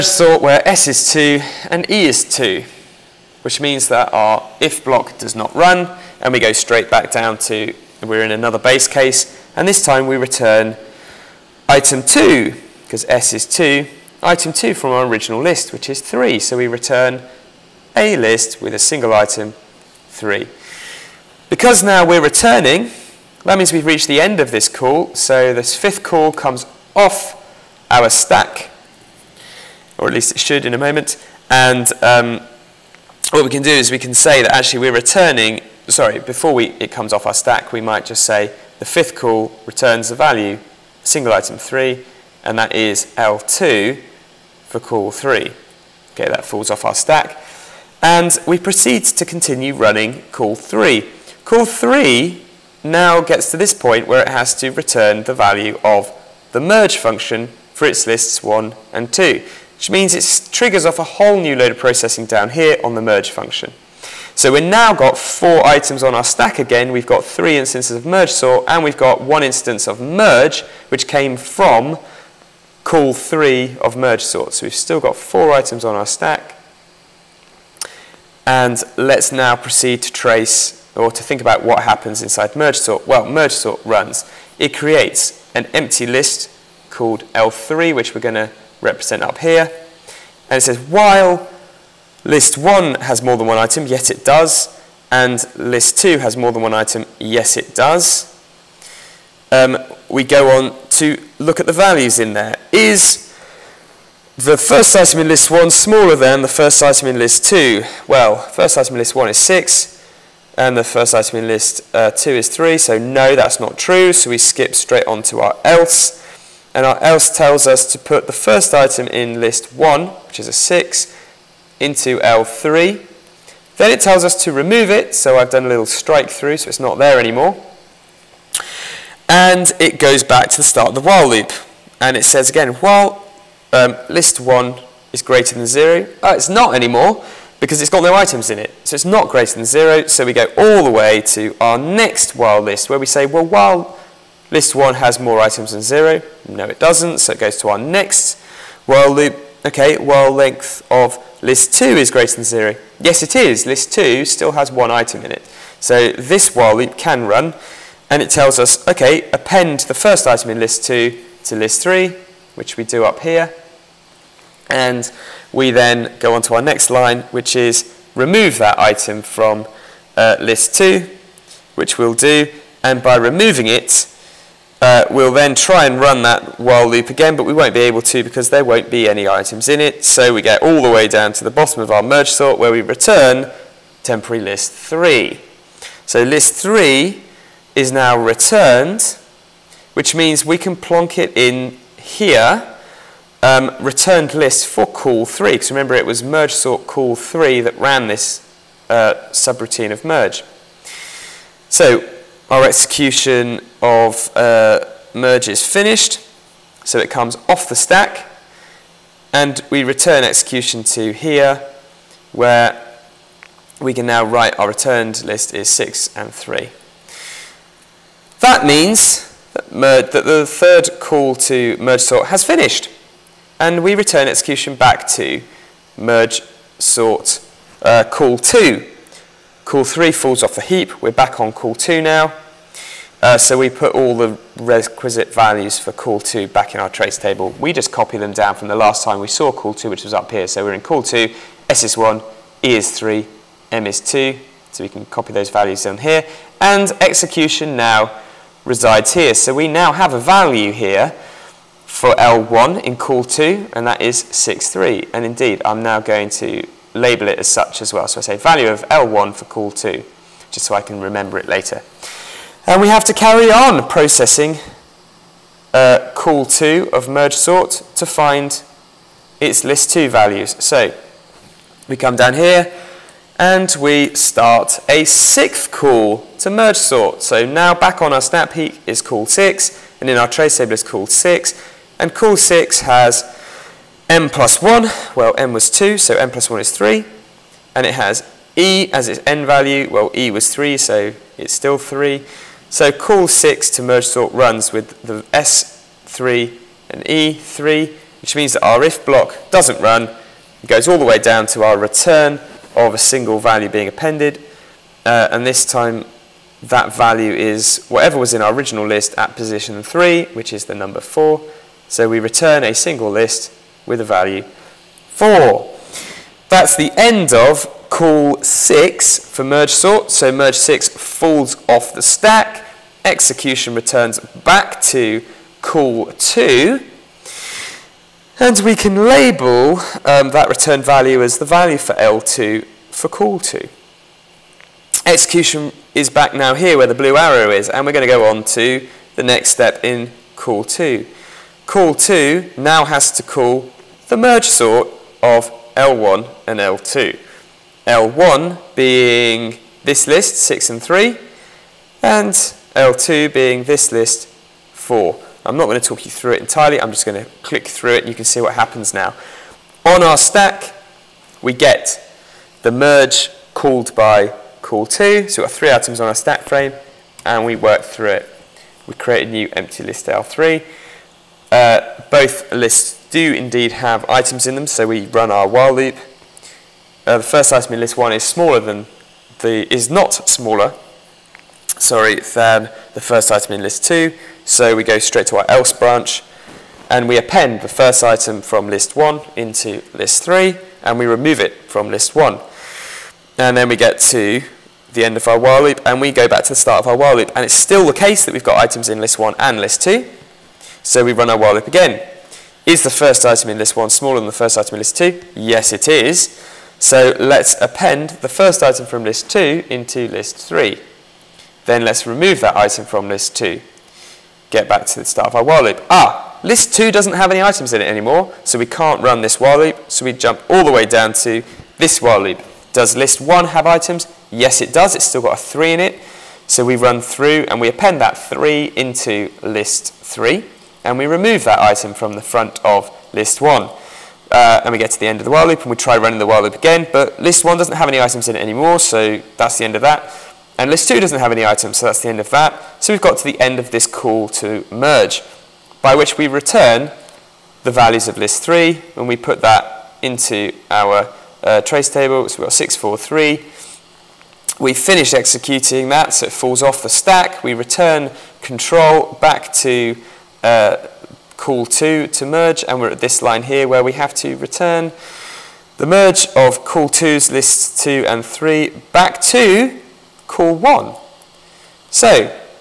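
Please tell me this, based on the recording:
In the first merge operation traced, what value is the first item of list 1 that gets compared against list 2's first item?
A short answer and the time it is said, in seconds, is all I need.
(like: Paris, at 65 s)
6, at 108 s.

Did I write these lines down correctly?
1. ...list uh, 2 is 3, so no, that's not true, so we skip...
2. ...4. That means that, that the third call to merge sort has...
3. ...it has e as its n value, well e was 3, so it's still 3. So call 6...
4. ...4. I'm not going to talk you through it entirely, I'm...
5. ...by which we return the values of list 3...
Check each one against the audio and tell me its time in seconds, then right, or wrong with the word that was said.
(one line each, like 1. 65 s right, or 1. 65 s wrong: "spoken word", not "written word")
1. 111 s right
2. 216 s wrong: "3", not "4"
3. 287 s right
4. 354 s right
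5. 445 s right.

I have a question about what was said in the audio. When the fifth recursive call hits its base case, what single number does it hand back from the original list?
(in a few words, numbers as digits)
3.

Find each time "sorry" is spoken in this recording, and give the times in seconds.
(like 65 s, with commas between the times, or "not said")
35 s, 381 s.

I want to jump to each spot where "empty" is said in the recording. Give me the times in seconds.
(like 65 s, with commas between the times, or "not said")
85 s, 369 s.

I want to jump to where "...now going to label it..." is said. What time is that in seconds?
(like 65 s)
255 s.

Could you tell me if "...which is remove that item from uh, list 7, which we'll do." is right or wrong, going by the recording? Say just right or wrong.
wrong.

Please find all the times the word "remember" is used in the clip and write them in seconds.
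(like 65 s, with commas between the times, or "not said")
195 s, 260 s.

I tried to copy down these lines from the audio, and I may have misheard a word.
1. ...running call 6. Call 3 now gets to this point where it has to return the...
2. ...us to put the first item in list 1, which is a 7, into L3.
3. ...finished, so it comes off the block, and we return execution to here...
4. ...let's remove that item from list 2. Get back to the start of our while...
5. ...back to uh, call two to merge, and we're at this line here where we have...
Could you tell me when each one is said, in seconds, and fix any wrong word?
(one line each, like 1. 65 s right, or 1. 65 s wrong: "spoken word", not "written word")
1. 49 s wrong: "3", not "6"
2. 117 s wrong: "6", not "7"
3. 205 s wrong: "stack", not "block"
4. 411 s right
5. 459 s right.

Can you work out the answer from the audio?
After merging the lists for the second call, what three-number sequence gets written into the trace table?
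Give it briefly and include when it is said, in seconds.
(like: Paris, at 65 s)
643, at 452 s.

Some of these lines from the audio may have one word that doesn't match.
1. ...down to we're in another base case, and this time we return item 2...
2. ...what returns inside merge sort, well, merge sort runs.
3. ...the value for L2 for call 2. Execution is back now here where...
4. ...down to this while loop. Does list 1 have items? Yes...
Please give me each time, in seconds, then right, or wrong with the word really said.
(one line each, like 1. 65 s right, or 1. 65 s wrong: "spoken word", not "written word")
1. 7 s right
2. 81 s wrong: "happens", not "returns"
3. 331 s right
4. 420 s right.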